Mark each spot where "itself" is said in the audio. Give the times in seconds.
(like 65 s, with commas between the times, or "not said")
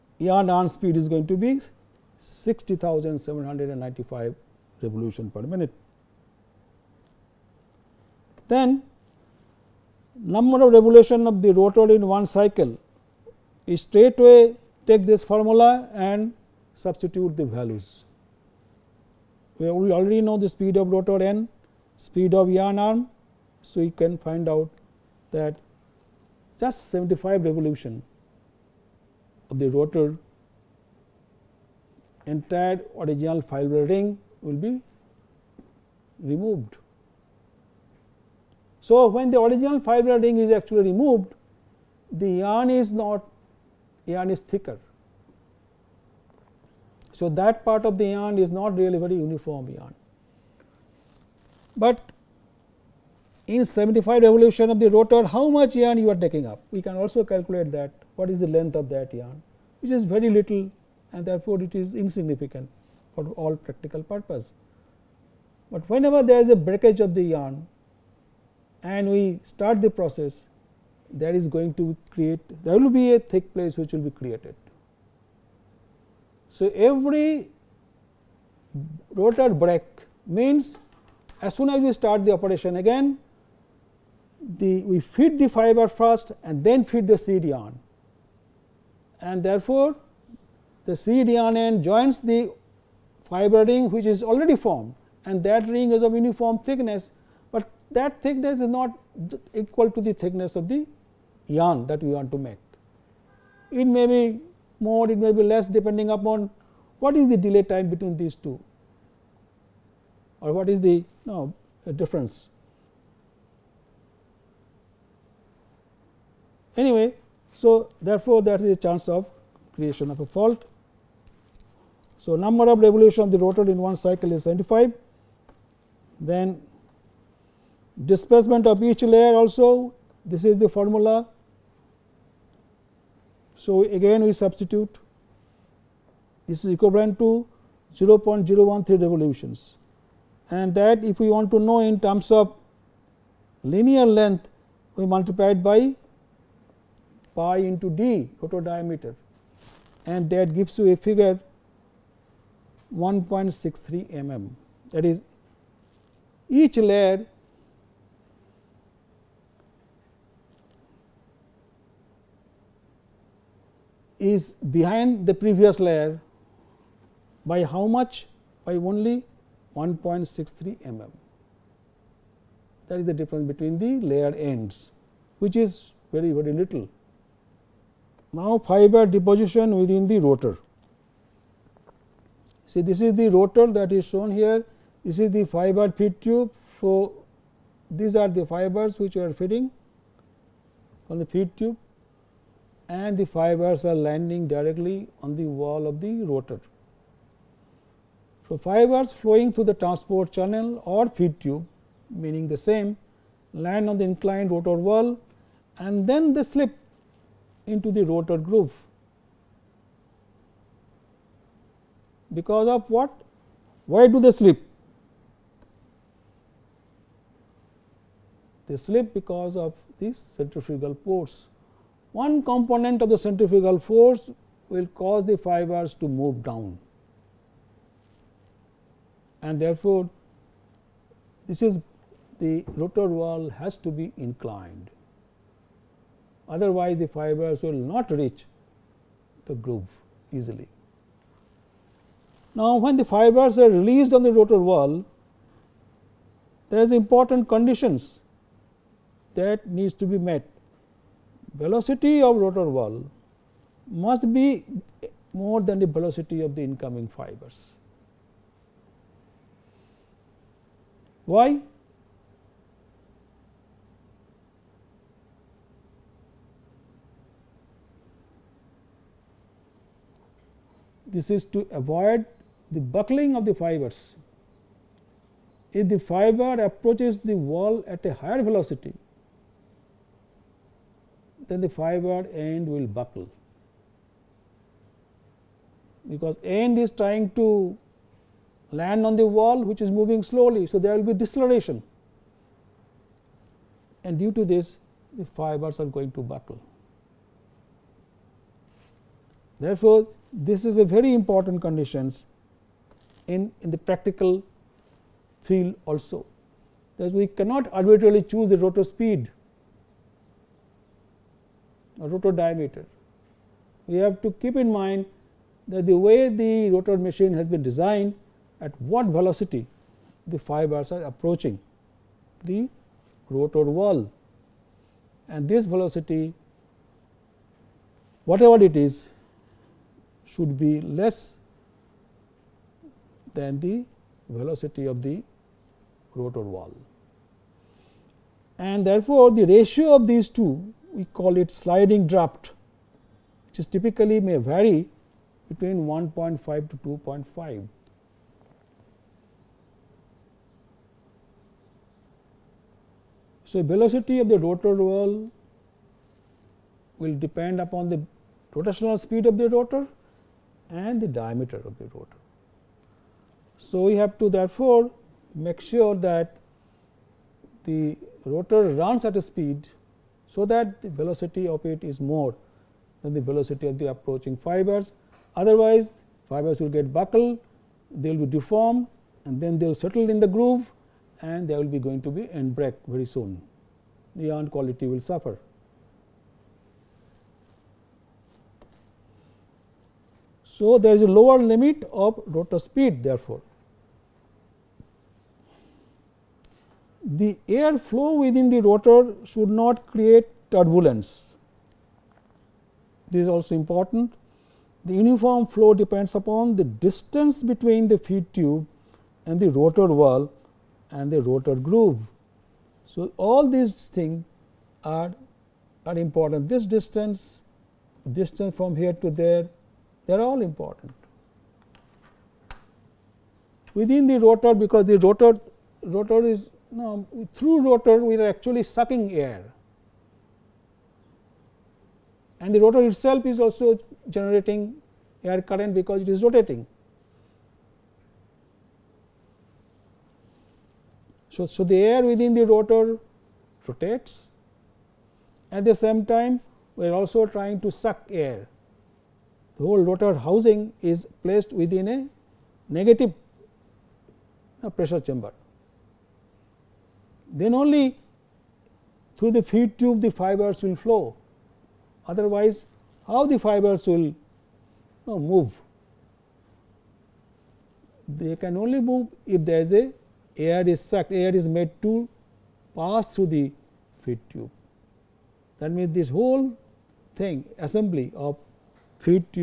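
432 s.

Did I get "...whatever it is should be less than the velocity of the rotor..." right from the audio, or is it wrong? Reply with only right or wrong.
right.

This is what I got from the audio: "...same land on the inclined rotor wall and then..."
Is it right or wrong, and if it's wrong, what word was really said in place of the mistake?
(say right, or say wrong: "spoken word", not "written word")
right.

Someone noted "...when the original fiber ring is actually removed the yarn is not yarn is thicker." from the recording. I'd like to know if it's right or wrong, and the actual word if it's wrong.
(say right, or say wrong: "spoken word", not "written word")
right.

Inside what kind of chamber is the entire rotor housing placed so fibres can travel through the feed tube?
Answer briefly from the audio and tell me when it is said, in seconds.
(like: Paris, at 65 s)
negative pressure chamber, at 452 s.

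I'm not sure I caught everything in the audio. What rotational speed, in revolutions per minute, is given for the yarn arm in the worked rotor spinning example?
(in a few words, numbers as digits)
60,795.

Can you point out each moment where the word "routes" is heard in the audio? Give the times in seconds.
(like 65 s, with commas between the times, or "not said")
not said.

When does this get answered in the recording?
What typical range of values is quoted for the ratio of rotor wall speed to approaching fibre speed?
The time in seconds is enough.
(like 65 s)
345 s.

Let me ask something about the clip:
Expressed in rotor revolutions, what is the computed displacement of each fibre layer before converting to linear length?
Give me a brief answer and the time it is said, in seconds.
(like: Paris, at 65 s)
0.013 revolutions, at 137 s.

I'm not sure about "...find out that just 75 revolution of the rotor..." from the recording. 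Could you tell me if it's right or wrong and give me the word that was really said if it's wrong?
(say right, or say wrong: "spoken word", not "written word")
right.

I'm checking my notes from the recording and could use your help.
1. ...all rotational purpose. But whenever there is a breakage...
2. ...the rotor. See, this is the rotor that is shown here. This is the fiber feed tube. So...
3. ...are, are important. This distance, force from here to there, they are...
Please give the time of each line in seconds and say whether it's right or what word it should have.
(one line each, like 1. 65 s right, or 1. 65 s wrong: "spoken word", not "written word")
1. 63 s wrong: "practical", not "rotational"
2. 180 s right
3. 414 s wrong: "distance", not "force".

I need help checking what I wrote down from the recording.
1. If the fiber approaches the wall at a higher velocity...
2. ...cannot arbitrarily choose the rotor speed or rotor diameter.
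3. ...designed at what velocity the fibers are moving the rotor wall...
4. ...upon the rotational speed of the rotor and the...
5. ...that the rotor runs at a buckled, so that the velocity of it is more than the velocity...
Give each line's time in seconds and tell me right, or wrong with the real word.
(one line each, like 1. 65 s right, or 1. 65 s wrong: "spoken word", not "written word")
1. 275 s right
2. 307 s right
3. 317 s wrong: "approaching", not "moving"
4. 357 s right
5. 365 s wrong: "speed", not "buckled".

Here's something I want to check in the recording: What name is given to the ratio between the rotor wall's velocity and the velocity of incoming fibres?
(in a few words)
sliding draft.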